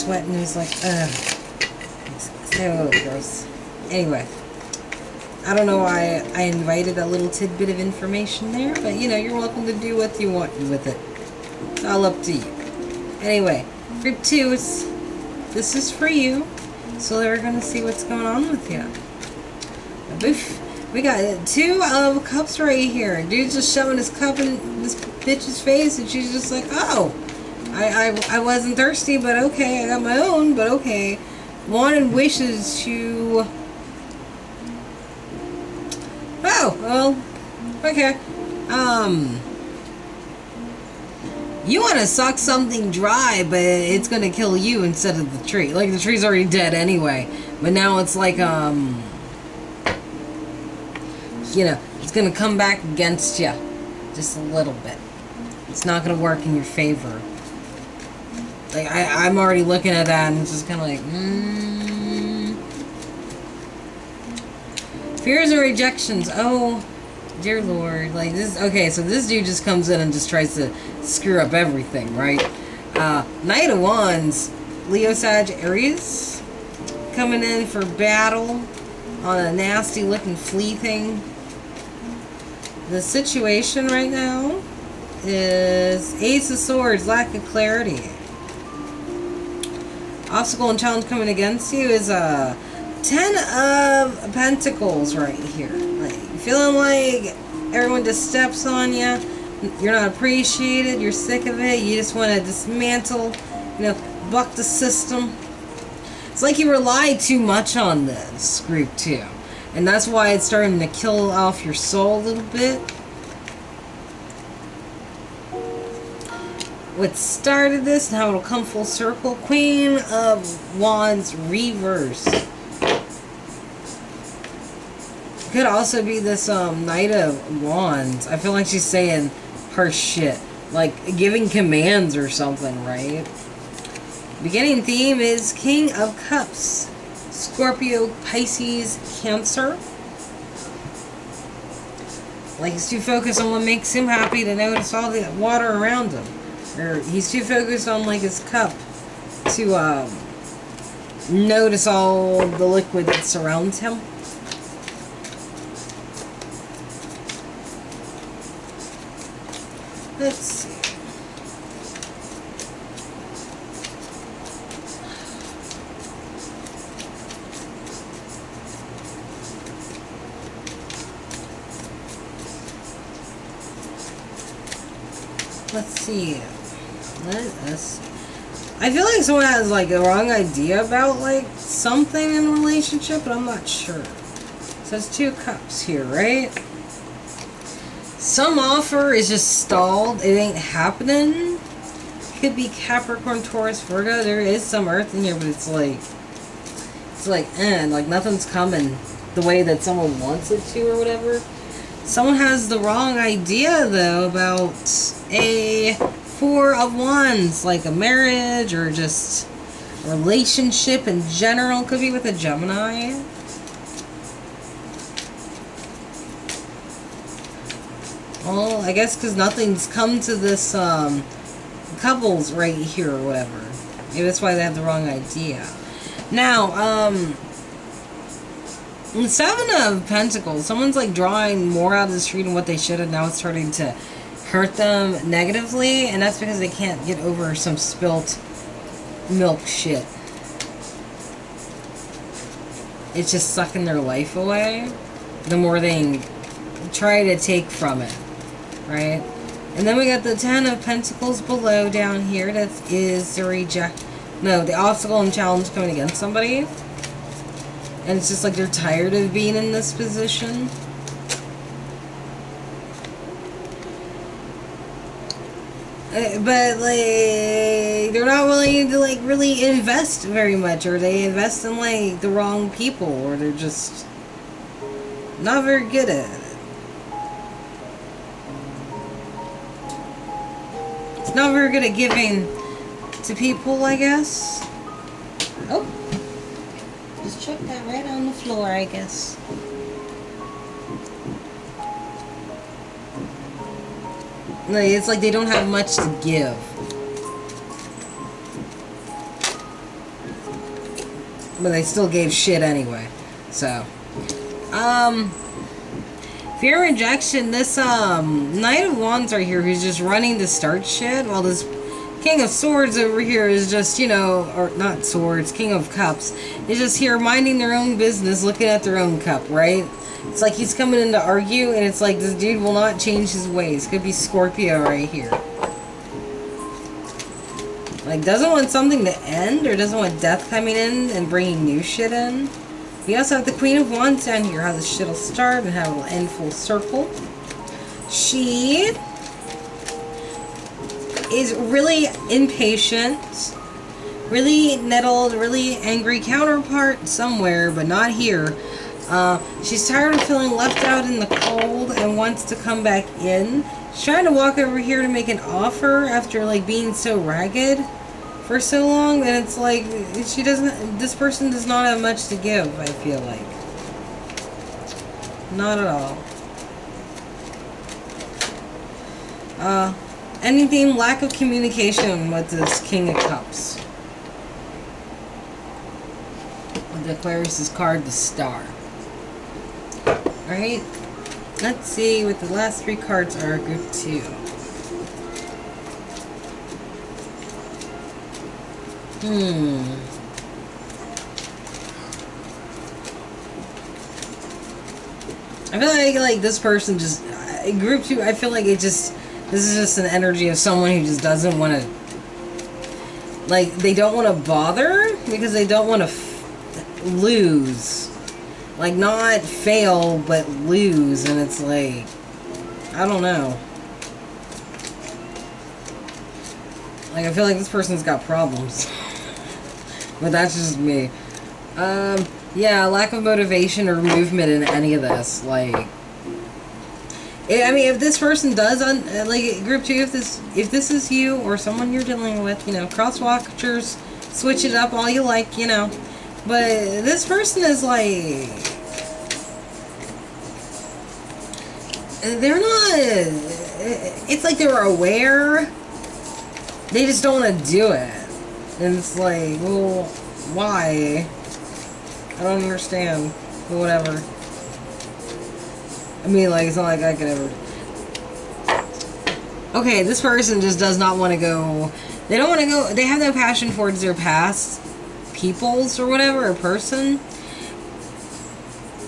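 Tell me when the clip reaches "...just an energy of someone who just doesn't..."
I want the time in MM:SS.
06:39.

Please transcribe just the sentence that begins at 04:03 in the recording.
It's just sucking their life away the more they try to take from it right?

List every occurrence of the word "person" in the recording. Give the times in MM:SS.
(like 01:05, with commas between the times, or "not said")
06:01, 06:36, 06:57, 07:08, 07:17, 07:40, 07:46.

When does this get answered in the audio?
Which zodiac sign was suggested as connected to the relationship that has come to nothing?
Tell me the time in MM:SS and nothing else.
03:32.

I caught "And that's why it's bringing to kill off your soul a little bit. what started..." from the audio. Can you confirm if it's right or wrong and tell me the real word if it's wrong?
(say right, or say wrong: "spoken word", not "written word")
wrong: "starting", not "bringing".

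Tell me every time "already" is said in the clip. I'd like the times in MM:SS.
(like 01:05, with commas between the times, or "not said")
00:46, 00:59.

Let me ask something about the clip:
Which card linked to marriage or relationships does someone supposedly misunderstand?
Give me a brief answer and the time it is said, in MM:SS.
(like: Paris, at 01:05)
Four of Wands, at 03:25.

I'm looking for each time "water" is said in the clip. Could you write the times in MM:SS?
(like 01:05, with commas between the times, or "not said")
02:25.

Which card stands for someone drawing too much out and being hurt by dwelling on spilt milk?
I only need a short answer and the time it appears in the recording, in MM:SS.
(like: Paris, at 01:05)
Seven of Pentacles, at 03:49.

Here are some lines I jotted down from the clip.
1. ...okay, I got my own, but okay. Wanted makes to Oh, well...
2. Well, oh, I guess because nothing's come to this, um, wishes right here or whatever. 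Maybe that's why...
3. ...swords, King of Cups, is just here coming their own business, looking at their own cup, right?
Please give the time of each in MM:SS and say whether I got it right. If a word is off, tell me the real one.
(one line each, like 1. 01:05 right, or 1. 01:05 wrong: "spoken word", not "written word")
1. 00:29 wrong: "wishes", not "makes"
2. 03:38 wrong: "couples", not "wishes"
3. 05:15 wrong: "minding", not "coming".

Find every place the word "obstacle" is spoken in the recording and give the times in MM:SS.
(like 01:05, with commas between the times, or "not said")
01:30, 04:14.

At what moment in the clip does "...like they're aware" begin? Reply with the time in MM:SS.
07:24.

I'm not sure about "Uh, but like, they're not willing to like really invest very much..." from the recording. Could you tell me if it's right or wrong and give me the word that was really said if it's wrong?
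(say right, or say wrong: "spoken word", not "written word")
right.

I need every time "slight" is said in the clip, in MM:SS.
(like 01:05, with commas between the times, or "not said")
not said.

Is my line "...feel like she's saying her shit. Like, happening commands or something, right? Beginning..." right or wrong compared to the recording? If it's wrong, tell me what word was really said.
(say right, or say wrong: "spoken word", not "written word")
wrong: "giving", not "happening".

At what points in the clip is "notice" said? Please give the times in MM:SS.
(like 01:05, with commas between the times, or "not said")
02:24, 02:31.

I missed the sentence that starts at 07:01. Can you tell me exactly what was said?
Um, yeah, lack of motivation or movement in any of this.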